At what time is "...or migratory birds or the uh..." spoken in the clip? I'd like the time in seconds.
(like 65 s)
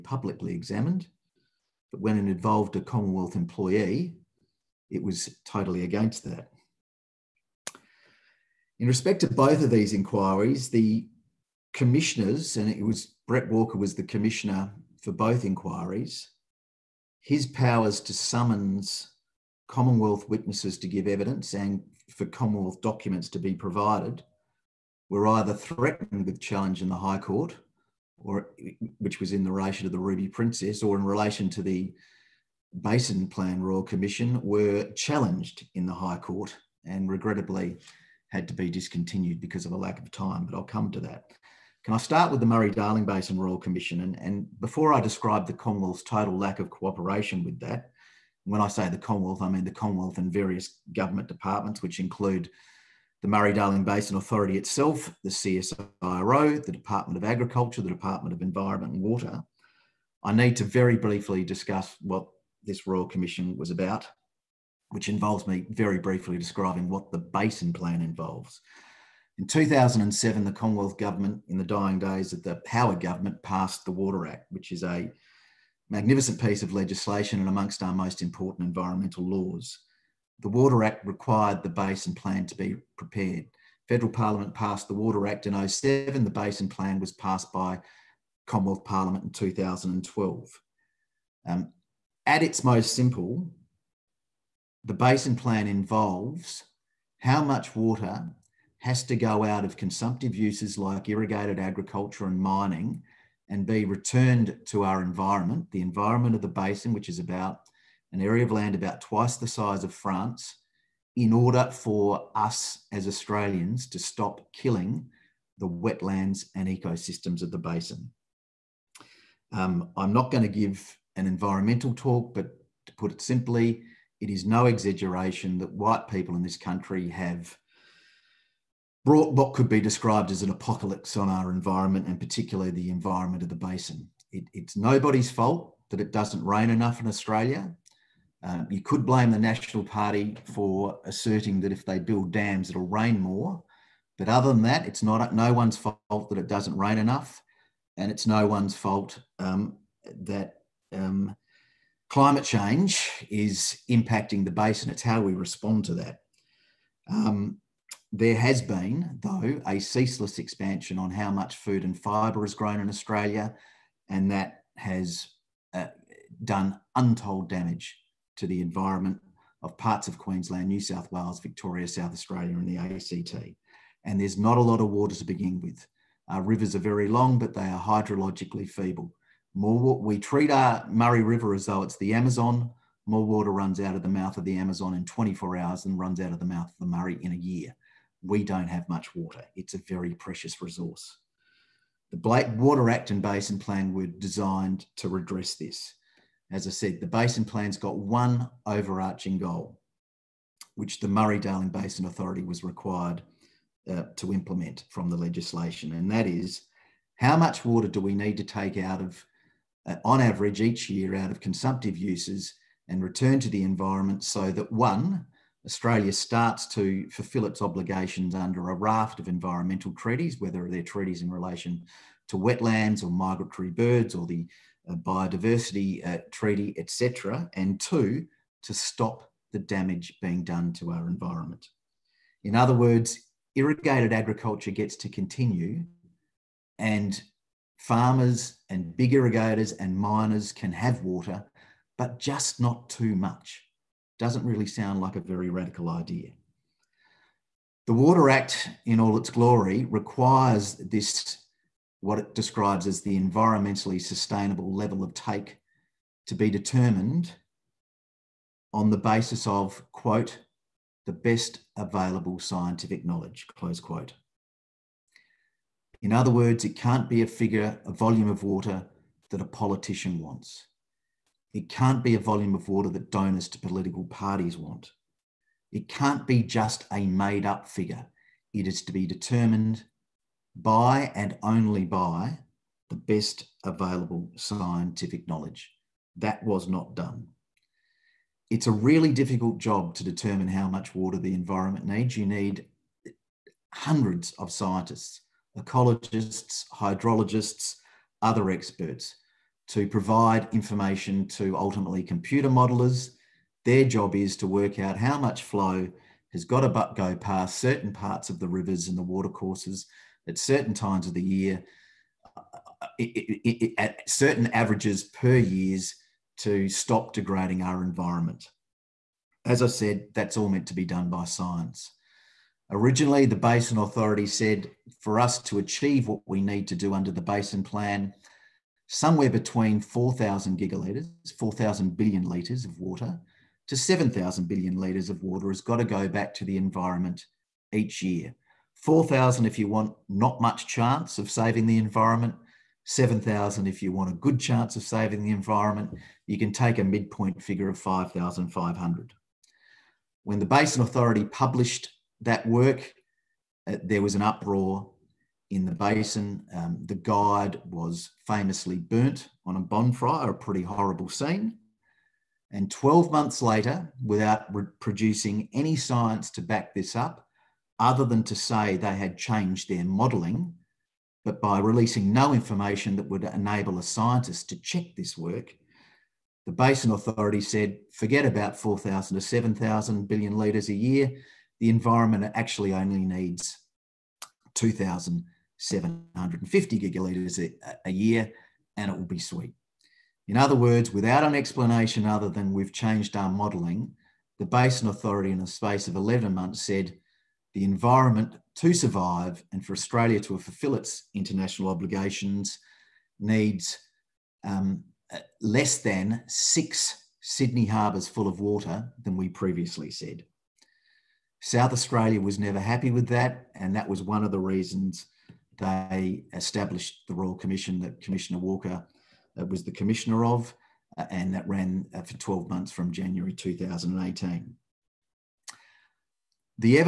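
223 s.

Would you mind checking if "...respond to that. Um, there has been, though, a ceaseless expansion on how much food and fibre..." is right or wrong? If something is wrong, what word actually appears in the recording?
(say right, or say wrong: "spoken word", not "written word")
right.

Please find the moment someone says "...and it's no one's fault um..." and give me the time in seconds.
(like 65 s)
147 s.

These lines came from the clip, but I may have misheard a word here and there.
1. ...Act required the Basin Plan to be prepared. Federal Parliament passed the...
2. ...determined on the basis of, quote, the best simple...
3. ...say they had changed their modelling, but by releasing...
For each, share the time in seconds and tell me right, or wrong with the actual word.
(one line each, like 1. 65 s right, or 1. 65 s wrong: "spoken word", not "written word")
1. 80 s right
2. 256 s wrong: "available", not "simple"
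3. 368 s right.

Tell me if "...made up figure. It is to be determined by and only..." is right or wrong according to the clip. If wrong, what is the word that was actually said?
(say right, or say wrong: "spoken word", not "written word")
right.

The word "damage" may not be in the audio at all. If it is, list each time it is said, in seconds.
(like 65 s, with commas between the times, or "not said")
167 s, 229 s.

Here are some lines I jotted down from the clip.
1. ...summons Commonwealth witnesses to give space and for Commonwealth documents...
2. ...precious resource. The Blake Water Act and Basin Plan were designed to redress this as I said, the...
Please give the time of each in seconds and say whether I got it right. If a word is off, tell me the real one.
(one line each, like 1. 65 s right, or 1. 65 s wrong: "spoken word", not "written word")
1. 18 s wrong: "evidence", not "space"
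2. 190 s right.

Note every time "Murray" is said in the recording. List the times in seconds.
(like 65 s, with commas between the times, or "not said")
42 s, 53 s, 180 s, 186 s, 201 s.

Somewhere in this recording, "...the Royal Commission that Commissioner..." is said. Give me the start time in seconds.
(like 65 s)
417 s.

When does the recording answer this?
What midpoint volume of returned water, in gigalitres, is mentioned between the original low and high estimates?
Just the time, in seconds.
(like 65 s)
347 s.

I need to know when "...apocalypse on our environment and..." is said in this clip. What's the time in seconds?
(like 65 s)
130 s.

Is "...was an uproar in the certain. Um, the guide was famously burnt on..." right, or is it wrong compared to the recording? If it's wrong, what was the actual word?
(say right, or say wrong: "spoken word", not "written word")
wrong: "basin", not "certain".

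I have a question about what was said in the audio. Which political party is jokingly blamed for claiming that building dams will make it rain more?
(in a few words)
National Party.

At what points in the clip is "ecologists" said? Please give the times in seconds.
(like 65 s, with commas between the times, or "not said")
295 s.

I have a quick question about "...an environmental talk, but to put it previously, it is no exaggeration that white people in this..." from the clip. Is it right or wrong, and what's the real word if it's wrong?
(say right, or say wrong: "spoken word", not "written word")
wrong: "simply", not "previously".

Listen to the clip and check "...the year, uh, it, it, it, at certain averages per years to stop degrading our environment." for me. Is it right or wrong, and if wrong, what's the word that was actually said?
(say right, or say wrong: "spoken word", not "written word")
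right.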